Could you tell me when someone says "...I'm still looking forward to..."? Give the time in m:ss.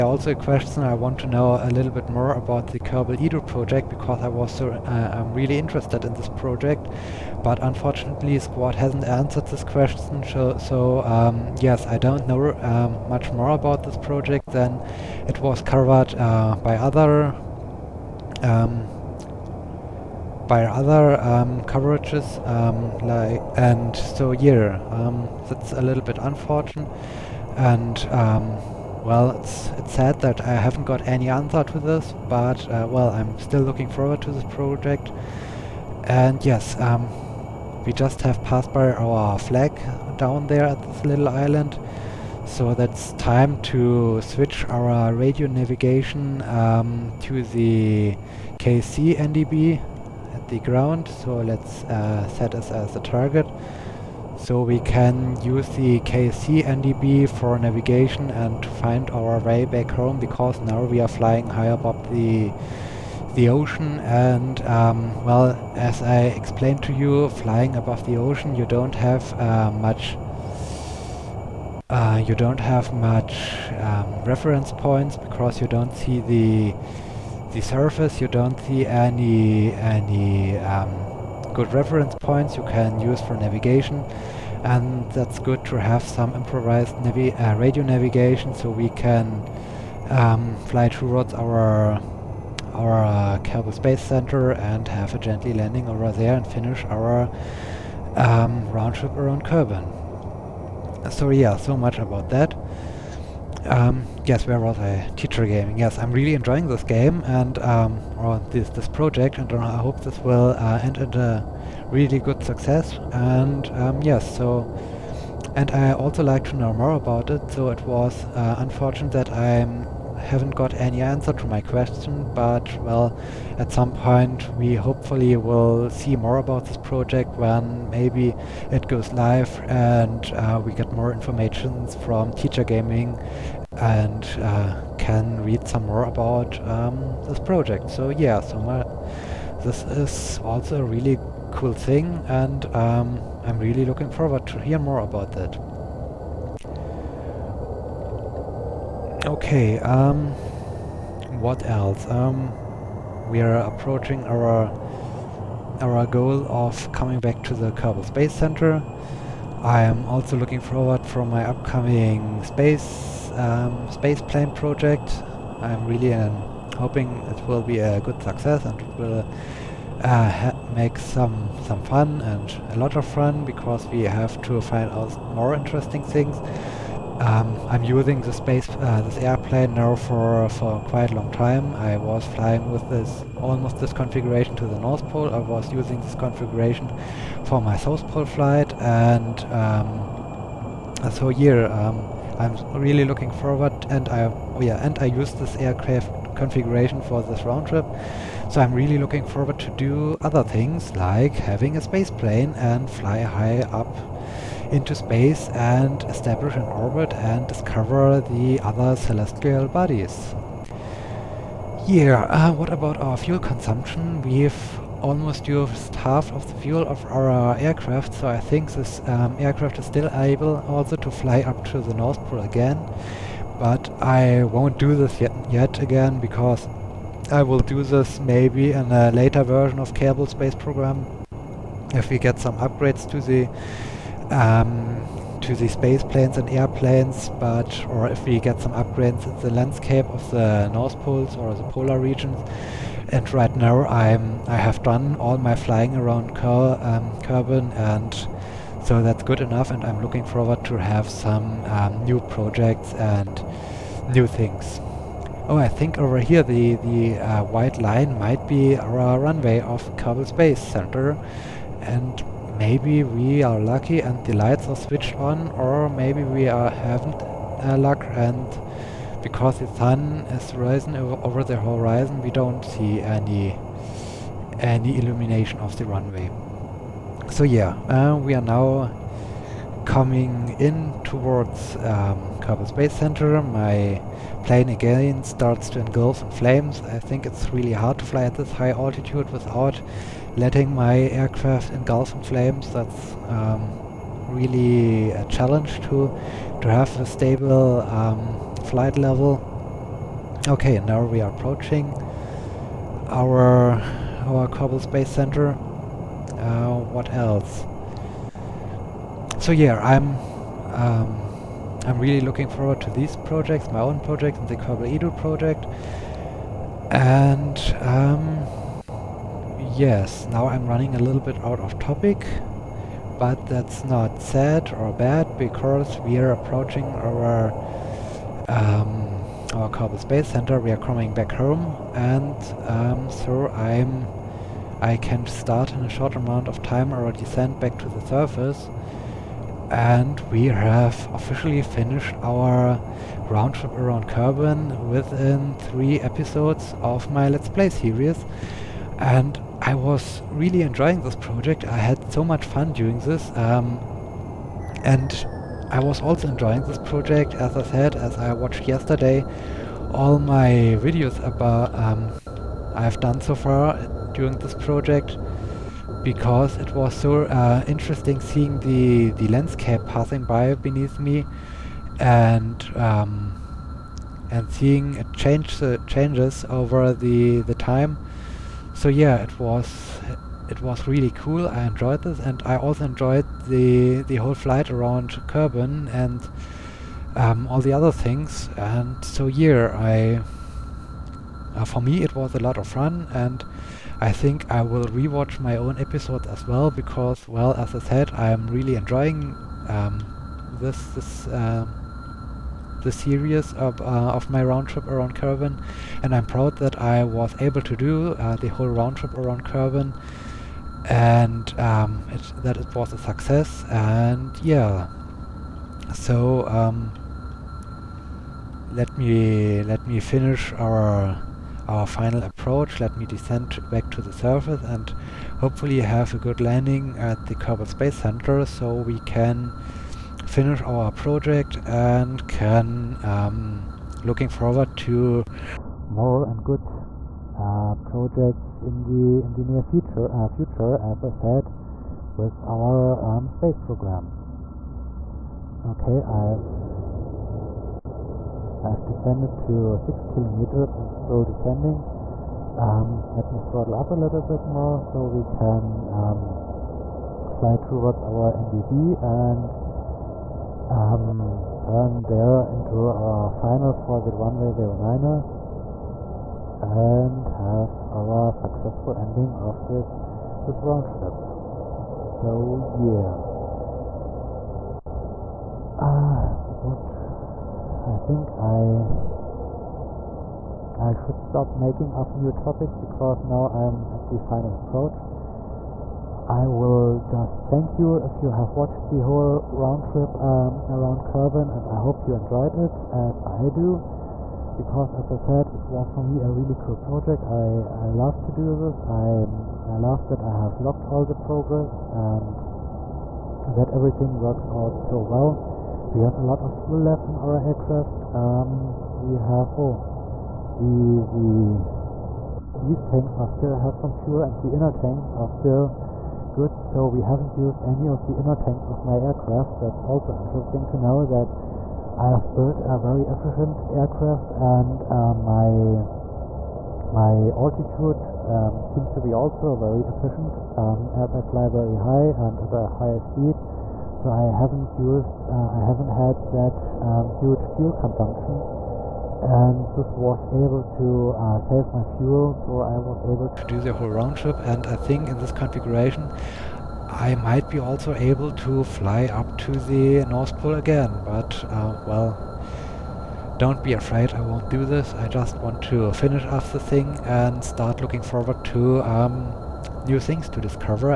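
0:33.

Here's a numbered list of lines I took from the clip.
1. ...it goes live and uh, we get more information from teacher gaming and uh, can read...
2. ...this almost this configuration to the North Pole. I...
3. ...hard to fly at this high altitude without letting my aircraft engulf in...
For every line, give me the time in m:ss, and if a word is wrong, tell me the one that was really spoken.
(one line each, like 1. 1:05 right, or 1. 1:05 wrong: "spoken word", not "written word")
1. 2:08 right
2. 3:02 right
3. 4:47 right.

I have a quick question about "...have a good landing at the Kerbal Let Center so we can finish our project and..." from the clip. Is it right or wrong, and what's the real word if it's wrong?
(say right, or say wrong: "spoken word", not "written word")
wrong: "Space", not "Let".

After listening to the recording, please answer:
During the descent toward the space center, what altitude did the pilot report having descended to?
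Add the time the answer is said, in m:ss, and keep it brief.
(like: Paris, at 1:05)
6 kilometers, at 7:29.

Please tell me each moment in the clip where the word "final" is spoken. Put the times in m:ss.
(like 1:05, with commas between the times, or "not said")
7:01, 7:43, 8:04.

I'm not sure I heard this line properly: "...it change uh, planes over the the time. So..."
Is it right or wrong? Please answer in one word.
wrong.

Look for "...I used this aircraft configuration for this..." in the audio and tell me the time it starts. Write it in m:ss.
3:14.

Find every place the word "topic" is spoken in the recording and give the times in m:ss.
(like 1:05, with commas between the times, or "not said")
5:21, 8:02.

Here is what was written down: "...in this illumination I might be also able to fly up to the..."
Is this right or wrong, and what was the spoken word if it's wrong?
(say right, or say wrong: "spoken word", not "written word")
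wrong: "configuration", not "illumination".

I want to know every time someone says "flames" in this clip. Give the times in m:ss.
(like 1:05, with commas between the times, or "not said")
4:46, 4:52.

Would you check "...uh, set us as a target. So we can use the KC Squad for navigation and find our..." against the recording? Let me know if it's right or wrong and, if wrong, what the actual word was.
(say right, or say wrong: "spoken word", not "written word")
wrong: "NDB", not "Squad".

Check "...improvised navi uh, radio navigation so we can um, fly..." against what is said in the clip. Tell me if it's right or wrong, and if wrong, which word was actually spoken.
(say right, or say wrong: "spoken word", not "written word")
right.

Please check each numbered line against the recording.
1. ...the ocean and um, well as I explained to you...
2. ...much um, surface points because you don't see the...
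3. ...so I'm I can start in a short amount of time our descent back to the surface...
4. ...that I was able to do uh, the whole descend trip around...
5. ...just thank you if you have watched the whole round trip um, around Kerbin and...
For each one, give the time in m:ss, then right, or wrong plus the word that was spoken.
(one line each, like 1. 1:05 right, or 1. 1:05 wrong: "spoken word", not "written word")
1. 1:03 right
2. 1:12 wrong: "reference", not "surface"
3. 5:33 right
4. 6:46 wrong: "round", not "descend"
5. 8:07 right.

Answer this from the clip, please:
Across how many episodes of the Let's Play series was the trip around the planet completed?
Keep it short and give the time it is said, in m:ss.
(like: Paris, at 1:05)
3, at 5:45.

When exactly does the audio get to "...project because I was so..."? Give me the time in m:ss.
0:03.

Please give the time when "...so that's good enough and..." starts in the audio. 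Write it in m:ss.
4:08.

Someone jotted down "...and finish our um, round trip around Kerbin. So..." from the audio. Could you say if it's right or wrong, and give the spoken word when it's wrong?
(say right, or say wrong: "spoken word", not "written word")
right.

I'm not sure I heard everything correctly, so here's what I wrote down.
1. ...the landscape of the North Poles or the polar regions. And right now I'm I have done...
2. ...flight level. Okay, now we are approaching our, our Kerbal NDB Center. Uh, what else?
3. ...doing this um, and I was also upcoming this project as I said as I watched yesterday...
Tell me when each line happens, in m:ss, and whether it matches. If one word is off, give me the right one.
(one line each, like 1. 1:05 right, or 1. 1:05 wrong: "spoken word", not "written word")
1. 3:59 right
2. 4:58 wrong: "Space", not "NDB"
3. 5:52 wrong: "enjoying", not "upcoming".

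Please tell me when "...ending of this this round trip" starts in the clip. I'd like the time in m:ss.
7:48.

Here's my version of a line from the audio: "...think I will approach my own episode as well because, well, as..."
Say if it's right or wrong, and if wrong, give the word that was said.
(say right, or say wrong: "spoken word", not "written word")
wrong: "rewatch", not "approach".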